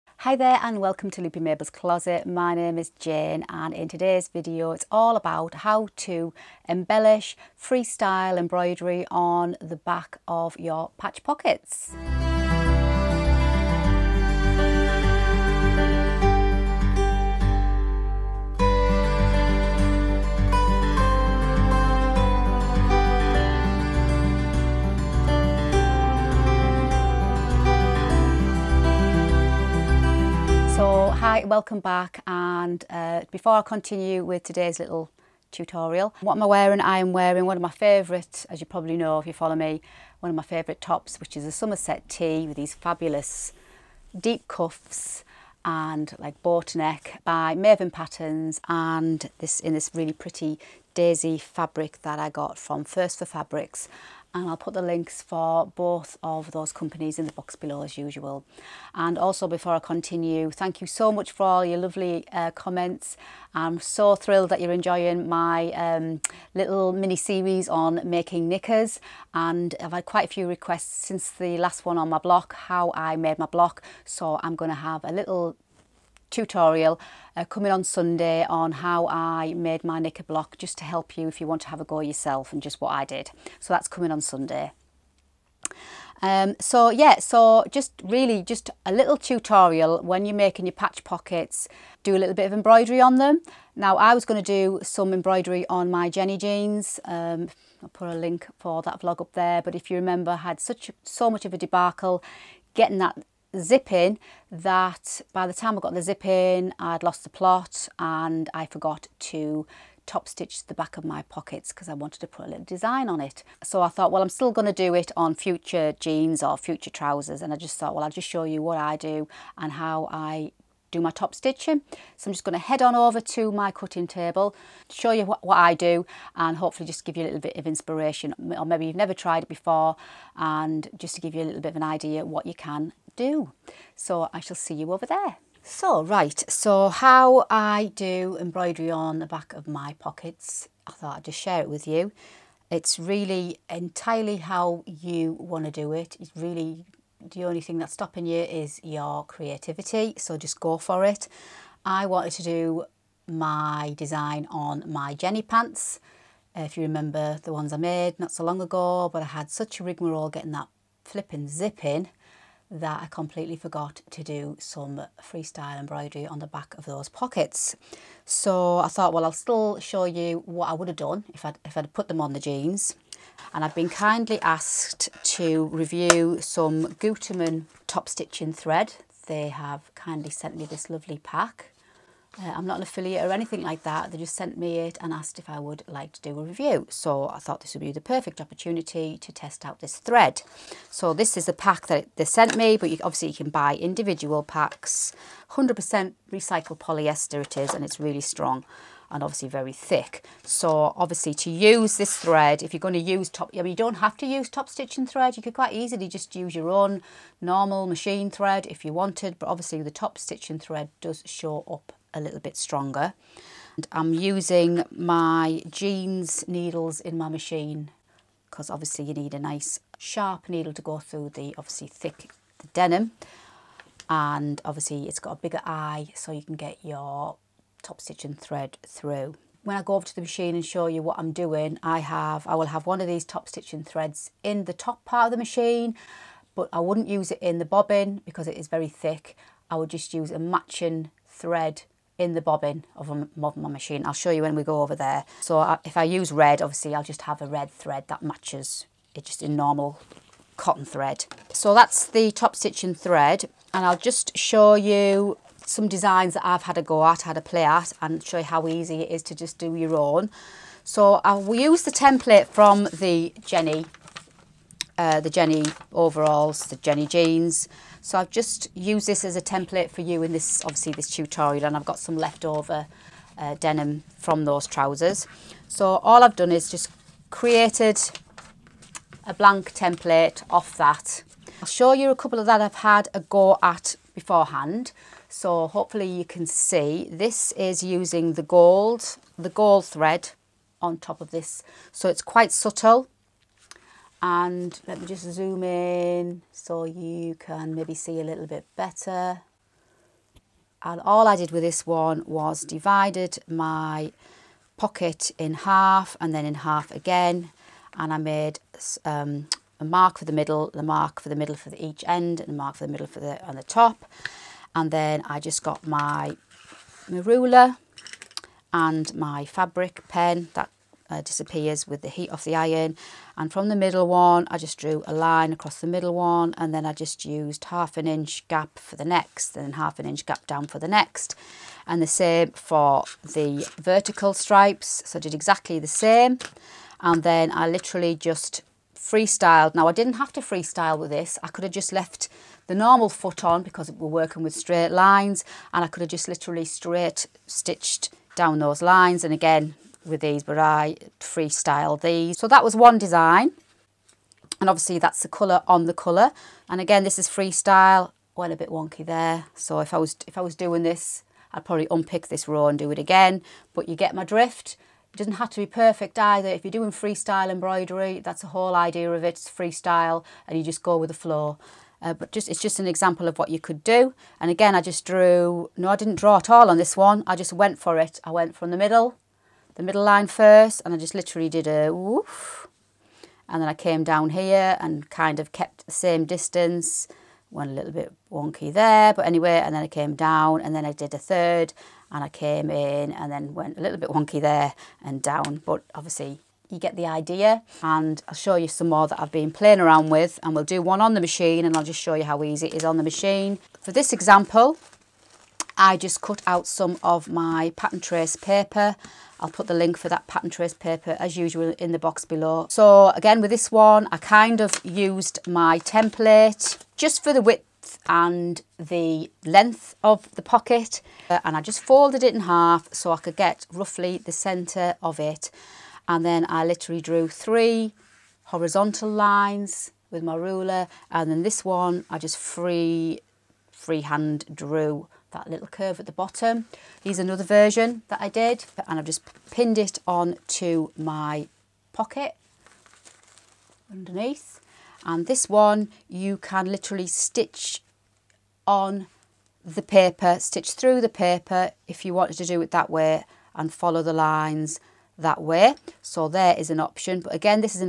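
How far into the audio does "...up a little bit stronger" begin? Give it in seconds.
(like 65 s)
211 s.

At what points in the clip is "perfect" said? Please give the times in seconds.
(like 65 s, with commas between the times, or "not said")
187 s, 365 s.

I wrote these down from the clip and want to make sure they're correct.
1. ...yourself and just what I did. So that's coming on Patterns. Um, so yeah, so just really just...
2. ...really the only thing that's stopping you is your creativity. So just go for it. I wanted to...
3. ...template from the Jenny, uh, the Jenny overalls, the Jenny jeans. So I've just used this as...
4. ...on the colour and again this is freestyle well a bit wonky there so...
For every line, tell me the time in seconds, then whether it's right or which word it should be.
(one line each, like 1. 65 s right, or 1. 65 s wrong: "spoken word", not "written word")
1. 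81 s wrong: "Sunday", not "Patterns"
2. 146 s right
3. 261 s right
4. 355 s right.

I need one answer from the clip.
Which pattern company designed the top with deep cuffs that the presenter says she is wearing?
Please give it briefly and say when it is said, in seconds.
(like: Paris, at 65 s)
Maven Patterns, at 47 s.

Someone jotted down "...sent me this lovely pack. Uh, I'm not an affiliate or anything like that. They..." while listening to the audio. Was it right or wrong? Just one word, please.
right.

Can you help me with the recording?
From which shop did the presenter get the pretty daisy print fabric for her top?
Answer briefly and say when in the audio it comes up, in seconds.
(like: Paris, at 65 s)
First for Fabrics, at 52 s.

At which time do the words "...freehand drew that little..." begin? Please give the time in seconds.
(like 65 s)
433 s.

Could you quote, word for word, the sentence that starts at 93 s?
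Now I was going to do some embroidery on my Jenny jeans.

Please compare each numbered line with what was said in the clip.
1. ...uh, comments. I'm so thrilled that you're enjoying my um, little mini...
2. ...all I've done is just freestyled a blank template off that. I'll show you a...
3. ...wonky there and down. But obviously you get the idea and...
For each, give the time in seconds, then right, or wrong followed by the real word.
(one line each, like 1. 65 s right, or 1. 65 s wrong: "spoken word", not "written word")
1. 62 s right
2. 275 s wrong: "created", not "freestyled"
3. 394 s right.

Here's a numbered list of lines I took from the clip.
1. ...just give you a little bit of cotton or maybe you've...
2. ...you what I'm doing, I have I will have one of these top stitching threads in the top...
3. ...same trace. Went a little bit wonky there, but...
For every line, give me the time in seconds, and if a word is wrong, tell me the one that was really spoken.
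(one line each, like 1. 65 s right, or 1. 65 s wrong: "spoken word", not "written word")
1. 126 s wrong: "inspiration", not "cotton"
2. 230 s right
3. 385 s wrong: "distance", not "trace".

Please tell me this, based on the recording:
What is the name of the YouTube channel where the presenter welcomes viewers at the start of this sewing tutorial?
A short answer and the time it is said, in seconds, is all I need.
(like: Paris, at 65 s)
Loopy Mabel's Closet, at 1 s.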